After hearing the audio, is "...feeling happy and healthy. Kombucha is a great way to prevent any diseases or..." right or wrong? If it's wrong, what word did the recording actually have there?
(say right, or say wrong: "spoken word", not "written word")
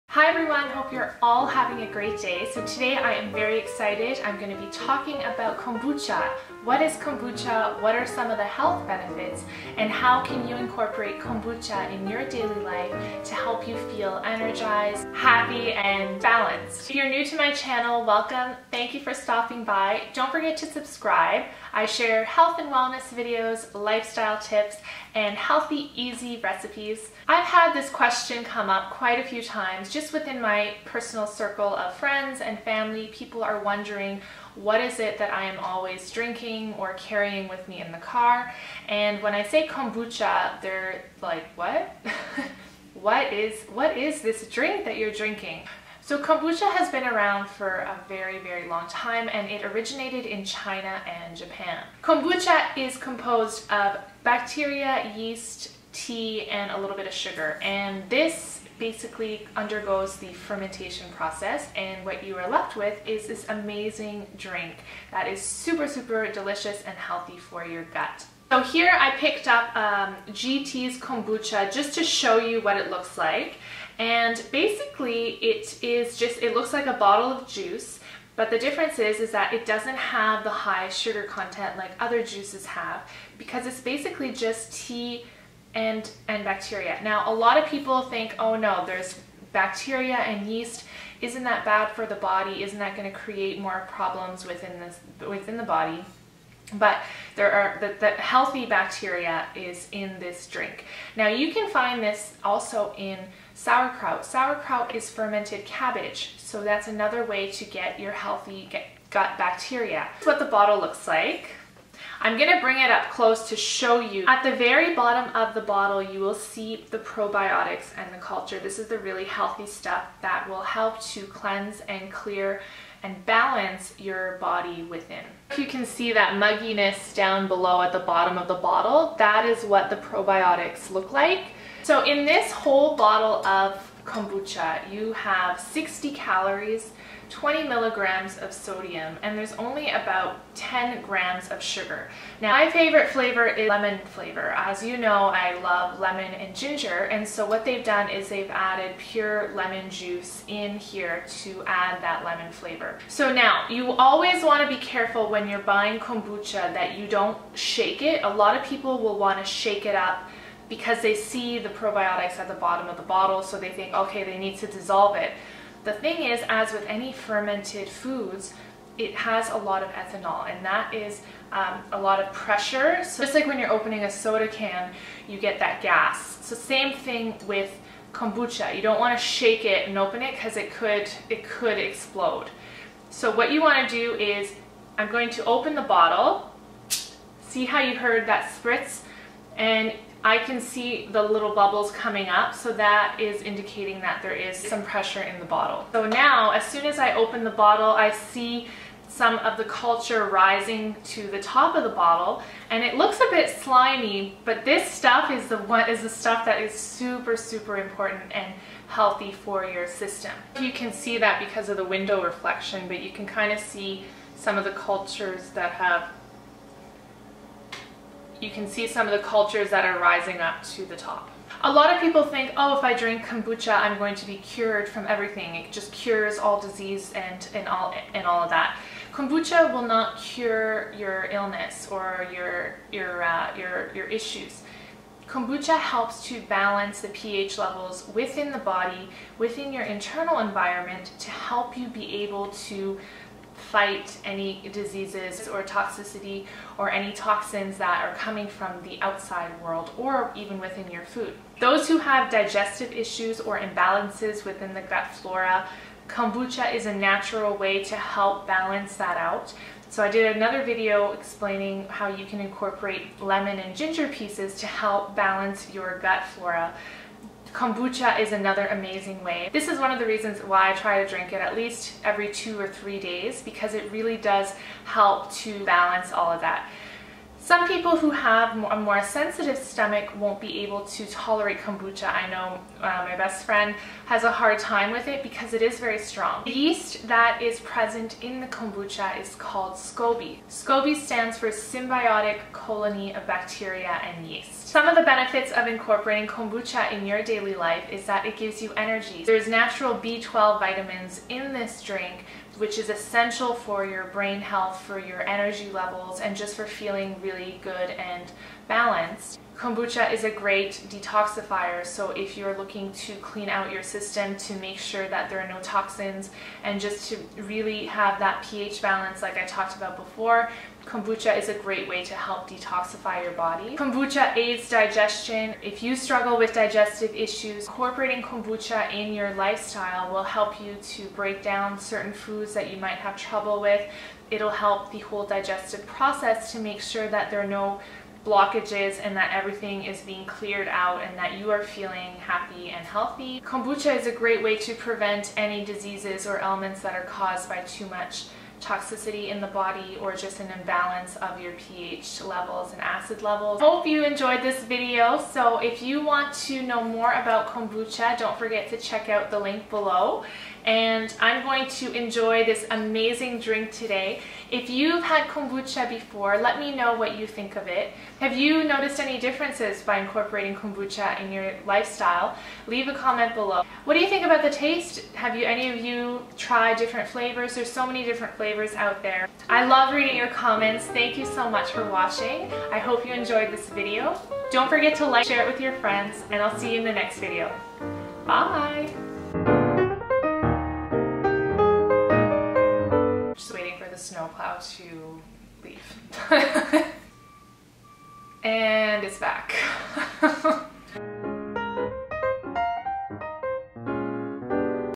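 right.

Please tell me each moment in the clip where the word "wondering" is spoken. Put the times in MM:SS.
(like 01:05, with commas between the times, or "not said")
00:33.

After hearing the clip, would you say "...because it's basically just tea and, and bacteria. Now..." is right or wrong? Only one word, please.
right.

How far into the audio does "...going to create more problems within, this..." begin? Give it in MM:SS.
01:32.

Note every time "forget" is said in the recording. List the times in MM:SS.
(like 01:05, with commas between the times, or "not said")
00:20, 05:58, 06:24.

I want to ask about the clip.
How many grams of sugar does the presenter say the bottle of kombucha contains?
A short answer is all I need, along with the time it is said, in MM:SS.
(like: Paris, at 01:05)
10 grams, at 02:20.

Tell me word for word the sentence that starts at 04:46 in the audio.
The yeast that is present in the kombucha is called SCOBY.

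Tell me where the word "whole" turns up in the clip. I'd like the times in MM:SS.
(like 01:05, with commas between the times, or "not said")
02:12, 05:34.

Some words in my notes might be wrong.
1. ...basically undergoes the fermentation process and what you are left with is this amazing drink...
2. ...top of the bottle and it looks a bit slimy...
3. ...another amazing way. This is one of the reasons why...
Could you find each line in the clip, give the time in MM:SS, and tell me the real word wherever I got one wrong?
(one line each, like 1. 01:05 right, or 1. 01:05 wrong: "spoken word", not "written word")
1. 00:58 right
2. 03:21 right
3. 04:28 right.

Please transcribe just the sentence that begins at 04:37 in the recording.
Some people who have a more sensitive stomach won't be able to tolerate kombucha.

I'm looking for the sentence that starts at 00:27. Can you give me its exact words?
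I've had this question come up quite a few times just within my personal circle of friends and family.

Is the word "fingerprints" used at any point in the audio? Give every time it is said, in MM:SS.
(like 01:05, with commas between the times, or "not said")
not said.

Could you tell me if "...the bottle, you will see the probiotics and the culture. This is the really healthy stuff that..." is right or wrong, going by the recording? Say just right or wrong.
right.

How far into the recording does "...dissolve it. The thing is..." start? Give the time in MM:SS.
02:44.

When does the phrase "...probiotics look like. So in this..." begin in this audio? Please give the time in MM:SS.
02:09.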